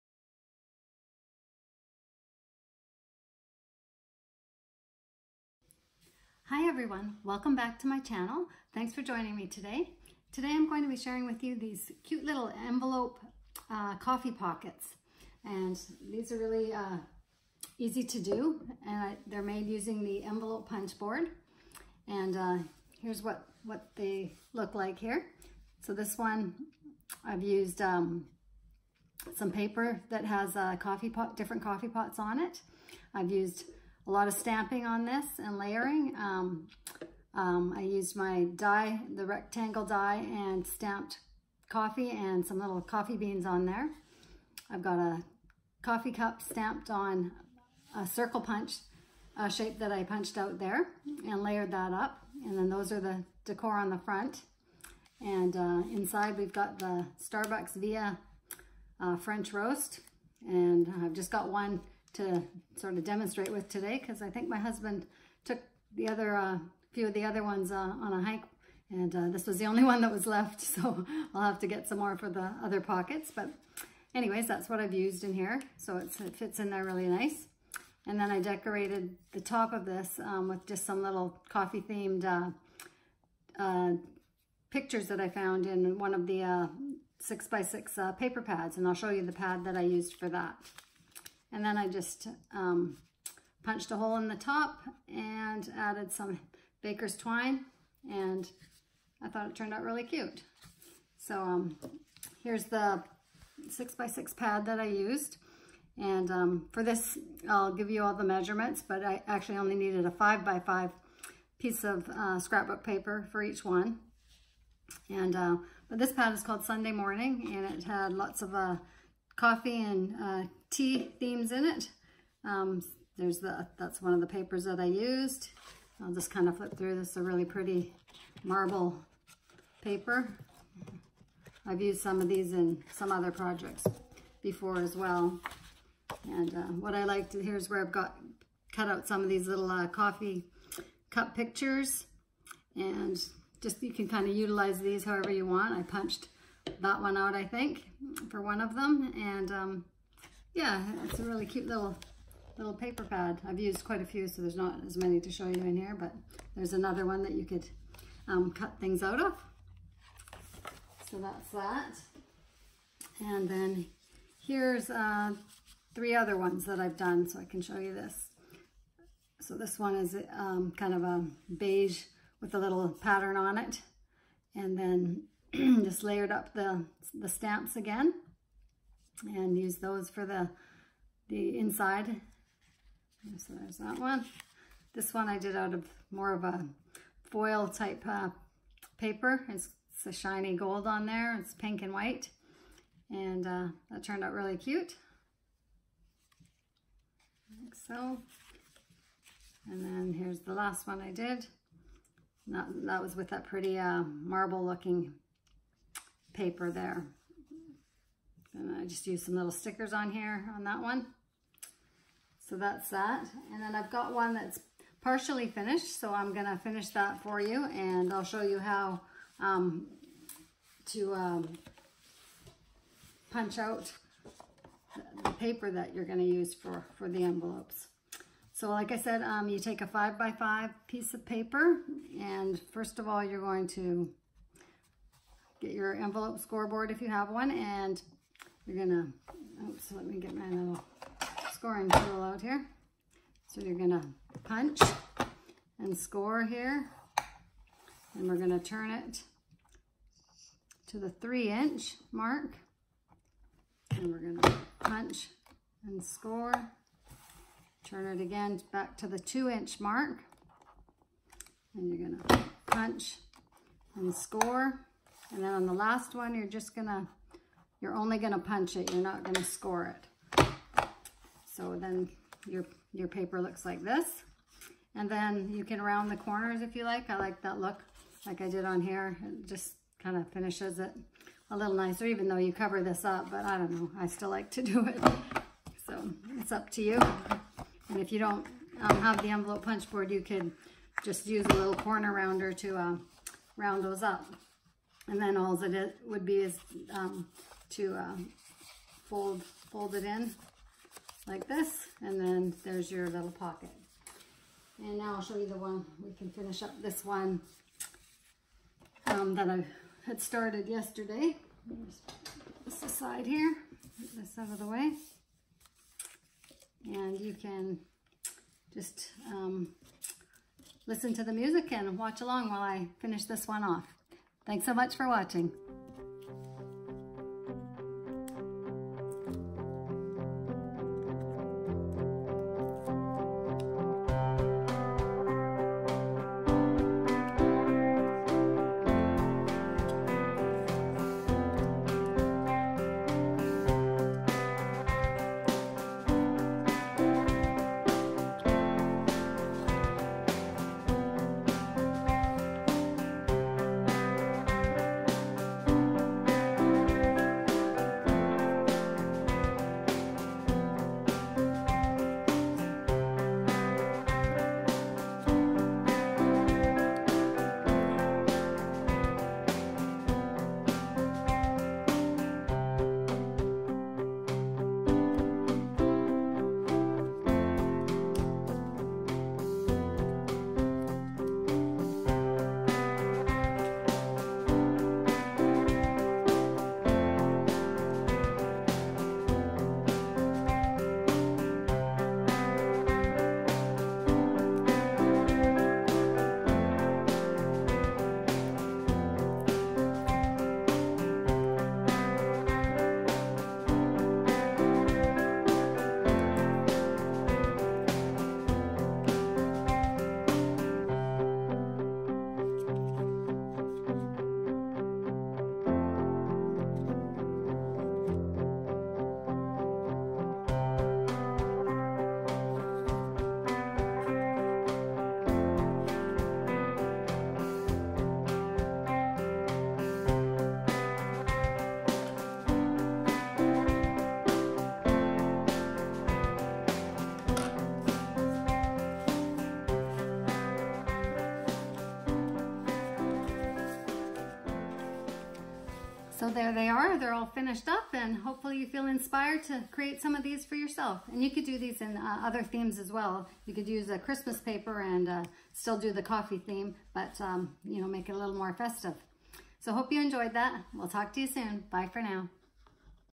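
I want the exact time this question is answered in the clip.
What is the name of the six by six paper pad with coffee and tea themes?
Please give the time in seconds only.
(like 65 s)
116 s.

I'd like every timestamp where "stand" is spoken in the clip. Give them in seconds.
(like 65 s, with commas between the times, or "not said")
not said.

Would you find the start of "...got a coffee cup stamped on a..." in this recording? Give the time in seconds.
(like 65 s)
44 s.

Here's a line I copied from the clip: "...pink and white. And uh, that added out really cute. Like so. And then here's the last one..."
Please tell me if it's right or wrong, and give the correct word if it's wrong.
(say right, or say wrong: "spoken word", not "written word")
wrong: "turned", not "added".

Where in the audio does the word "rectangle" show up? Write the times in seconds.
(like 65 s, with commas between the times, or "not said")
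39 s.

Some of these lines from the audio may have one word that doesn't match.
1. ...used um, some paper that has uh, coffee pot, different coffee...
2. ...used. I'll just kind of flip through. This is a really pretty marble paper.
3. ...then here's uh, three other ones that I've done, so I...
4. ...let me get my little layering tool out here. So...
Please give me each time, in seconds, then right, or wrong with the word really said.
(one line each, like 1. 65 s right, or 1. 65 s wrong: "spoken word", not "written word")
1. 27 s right
2. 124 s right
3. 163 s right
4. 239 s wrong: "scoring", not "layering".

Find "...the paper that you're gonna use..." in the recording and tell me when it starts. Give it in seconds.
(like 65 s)
225 s.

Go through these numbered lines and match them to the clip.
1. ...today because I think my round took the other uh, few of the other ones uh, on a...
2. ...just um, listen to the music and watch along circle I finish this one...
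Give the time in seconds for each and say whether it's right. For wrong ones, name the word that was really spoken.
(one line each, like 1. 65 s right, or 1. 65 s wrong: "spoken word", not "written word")
1. 63 s wrong: "husband", not "round"
2. 318 s wrong: "while", not "circle".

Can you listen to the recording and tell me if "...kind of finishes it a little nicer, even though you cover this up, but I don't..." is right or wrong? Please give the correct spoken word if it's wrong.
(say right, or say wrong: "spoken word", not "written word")
right.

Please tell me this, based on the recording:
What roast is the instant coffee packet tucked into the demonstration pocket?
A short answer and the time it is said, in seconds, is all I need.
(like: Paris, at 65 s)
French roast, at 59 s.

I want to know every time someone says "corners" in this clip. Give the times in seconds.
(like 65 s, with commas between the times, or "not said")
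276 s, 291 s.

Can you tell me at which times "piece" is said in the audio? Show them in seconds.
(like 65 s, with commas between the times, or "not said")
111 s, 230 s.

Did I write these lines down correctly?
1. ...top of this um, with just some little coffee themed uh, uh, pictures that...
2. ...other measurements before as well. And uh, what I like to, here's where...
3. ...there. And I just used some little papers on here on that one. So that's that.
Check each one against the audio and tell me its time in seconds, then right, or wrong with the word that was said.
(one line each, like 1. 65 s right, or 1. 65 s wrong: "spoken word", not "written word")
1. 79 s right
2. 133 s wrong: "projects", not "measurements"
3. 206 s wrong: "stickers", not "papers".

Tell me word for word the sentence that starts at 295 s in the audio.
And then all it would be is um, to uh, fold, fold it in like this, and then there's your little pocket.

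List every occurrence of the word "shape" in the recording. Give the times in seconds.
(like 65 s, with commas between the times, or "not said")
49 s.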